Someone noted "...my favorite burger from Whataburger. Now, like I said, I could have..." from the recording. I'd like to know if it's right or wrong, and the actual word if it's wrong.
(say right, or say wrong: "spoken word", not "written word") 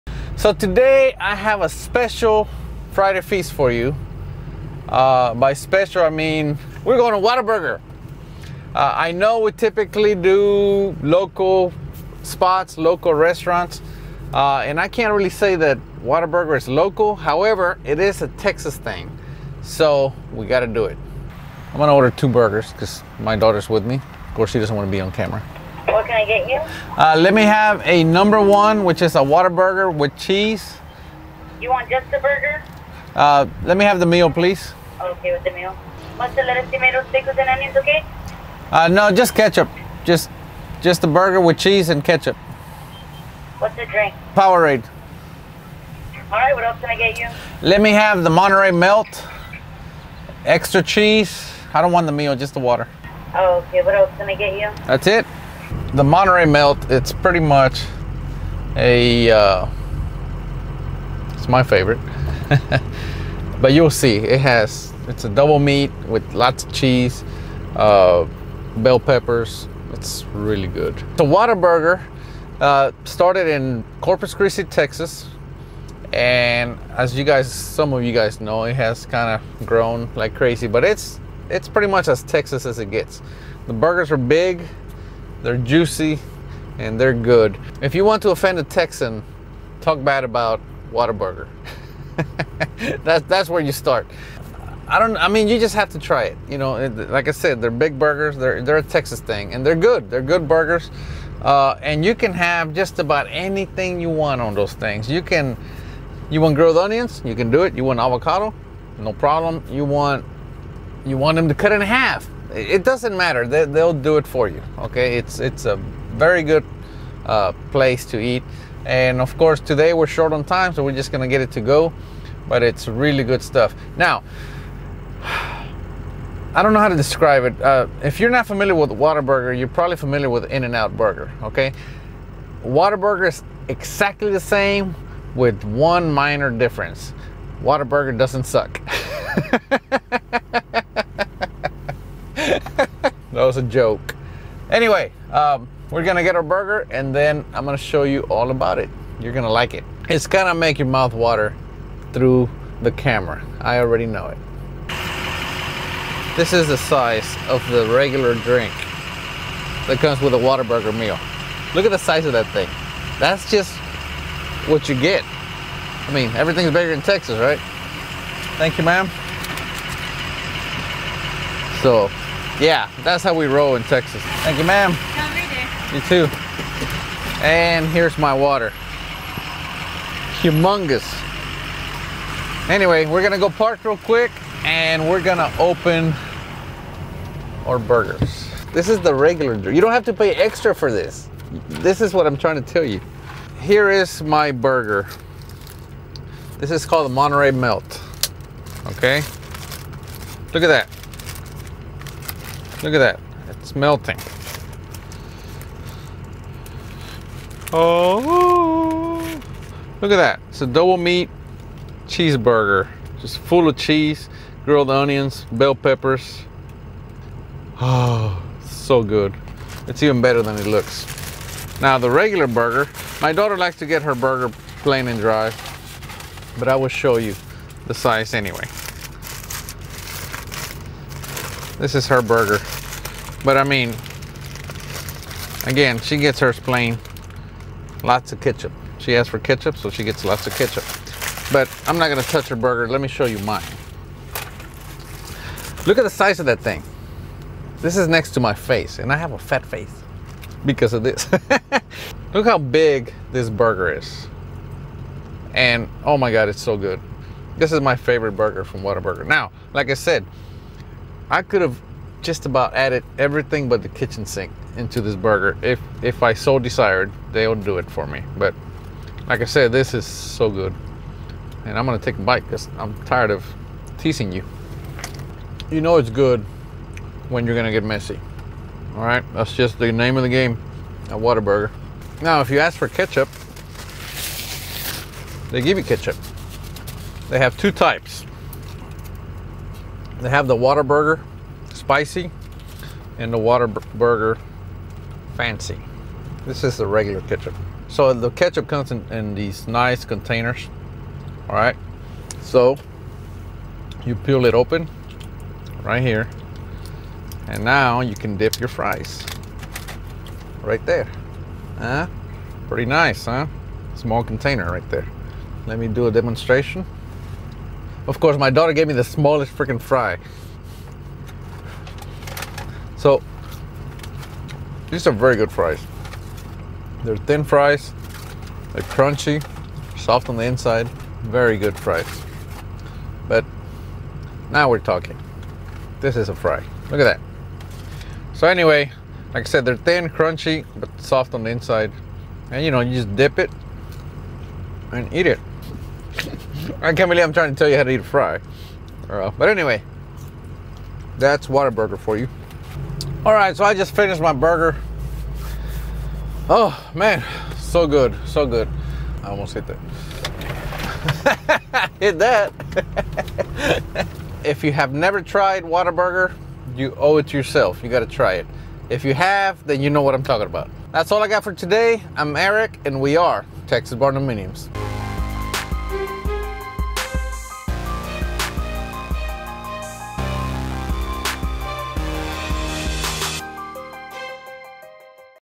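right.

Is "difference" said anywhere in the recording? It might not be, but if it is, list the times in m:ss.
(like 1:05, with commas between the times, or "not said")
2:16.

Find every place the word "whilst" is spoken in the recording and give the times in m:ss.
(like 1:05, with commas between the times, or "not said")
not said.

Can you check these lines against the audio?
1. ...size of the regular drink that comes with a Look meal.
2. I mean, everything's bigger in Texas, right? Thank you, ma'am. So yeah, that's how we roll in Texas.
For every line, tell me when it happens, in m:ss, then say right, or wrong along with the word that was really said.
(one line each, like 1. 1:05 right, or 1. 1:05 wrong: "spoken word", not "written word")
1. 2:36 wrong: "Whataburger", not "Look"
2. 2:45 right.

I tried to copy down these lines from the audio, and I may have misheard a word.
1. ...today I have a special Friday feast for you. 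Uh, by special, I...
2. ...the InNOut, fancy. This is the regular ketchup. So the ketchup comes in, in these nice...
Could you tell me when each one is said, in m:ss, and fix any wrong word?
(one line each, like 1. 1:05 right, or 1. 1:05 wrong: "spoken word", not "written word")
1. 0:00 right
2. 4:53 wrong: "Whataburger", not "InNOut".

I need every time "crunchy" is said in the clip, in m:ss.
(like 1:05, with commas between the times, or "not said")
5:28, 5:40.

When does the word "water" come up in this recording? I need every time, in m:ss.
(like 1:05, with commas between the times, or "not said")
0:52, 2:31, 2:58.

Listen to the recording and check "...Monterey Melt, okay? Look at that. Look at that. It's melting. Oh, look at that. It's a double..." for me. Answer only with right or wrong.
right.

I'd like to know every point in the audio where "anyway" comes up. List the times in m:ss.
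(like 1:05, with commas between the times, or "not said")
2:24, 3:02, 3:48, 5:38, 5:49.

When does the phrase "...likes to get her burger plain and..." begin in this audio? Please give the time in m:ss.
3:43.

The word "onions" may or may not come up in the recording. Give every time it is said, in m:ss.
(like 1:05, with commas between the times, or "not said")
0:37, 1:46, 3:34.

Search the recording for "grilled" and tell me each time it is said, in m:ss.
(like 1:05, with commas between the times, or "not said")
1:46, 3:34.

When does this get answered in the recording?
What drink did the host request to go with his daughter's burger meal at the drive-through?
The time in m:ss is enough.
0:44.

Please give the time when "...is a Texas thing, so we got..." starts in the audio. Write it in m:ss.
0:17.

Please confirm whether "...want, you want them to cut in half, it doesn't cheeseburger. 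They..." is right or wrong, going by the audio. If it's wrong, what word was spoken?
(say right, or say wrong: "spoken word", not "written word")
wrong: "matter", not "cheeseburger".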